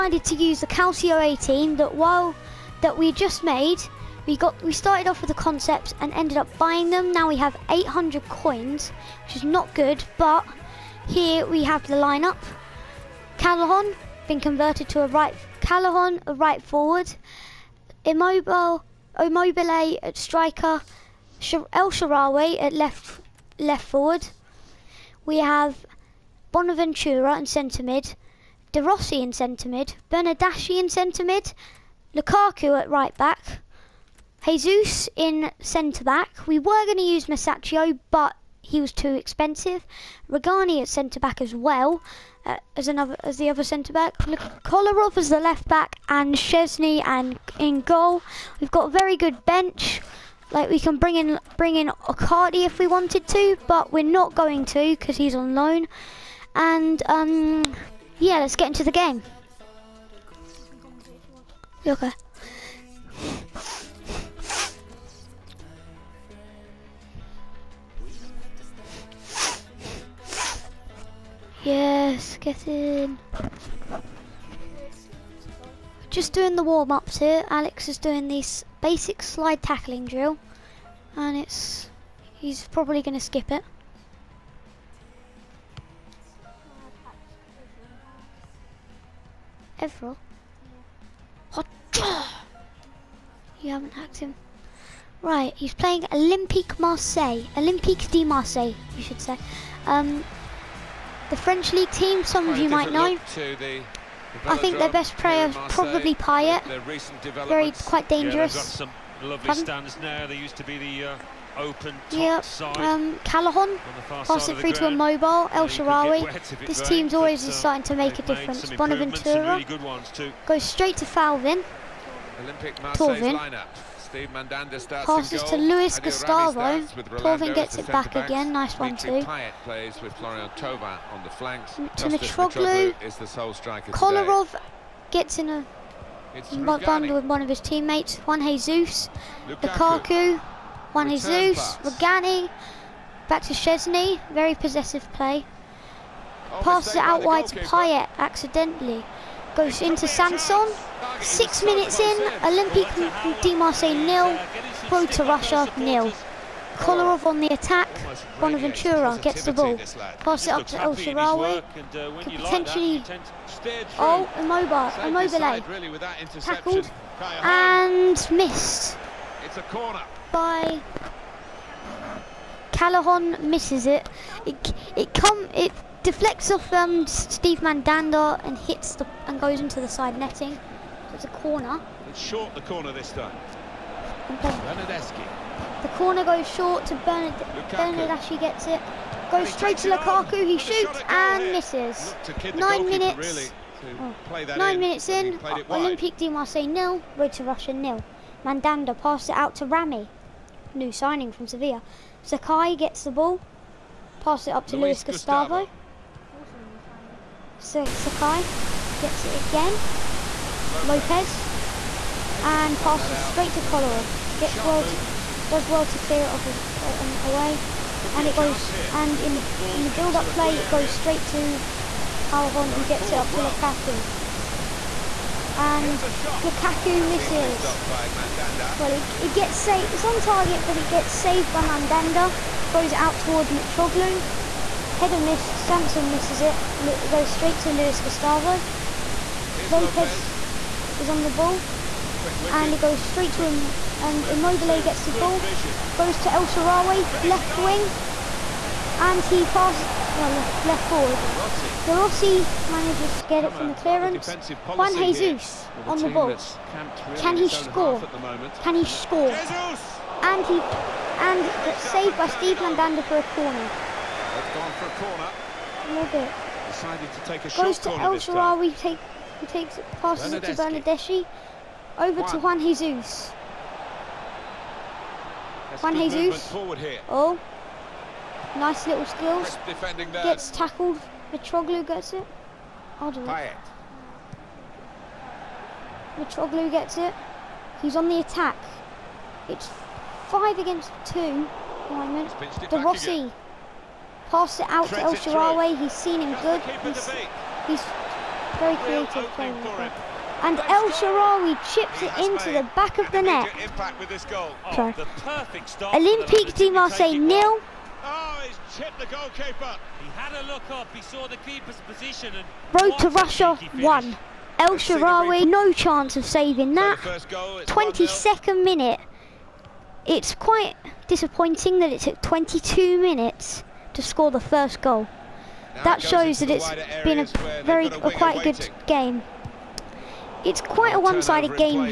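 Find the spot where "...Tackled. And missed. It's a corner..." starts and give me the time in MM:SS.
02:46.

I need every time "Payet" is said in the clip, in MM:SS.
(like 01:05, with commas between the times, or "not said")
01:46, 02:27.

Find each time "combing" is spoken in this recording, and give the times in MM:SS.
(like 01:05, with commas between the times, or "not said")
not said.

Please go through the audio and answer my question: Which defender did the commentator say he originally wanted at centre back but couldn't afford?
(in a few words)
Musacchio.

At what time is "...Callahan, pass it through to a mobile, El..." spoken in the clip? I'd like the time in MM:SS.
01:53.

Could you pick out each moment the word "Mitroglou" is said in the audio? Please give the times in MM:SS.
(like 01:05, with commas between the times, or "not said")
02:12, 03:53, 04:41, 04:46.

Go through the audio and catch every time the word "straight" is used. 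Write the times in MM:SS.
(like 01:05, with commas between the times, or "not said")
02:00, 03:09, 03:33, 03:40, 03:57, 04:02.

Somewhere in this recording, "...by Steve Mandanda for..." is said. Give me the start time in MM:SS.
04:22.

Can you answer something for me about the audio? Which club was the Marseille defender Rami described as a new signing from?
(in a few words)
Sevilla.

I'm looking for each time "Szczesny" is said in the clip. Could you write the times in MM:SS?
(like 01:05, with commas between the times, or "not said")
00:46, 02:23.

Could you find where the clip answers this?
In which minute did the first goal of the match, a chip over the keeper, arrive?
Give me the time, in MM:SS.
05:16.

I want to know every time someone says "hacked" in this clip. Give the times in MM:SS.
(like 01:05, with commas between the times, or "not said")
01:33.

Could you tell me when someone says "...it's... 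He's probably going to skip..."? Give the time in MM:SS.
01:21.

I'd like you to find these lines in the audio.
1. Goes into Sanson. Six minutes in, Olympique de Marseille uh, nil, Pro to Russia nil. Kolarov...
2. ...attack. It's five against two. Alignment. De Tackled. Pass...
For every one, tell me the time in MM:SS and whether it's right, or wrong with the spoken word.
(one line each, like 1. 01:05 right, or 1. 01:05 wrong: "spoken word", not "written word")
1. 02:29 right
2. 04:48 wrong: "Rossi", not "Tackled".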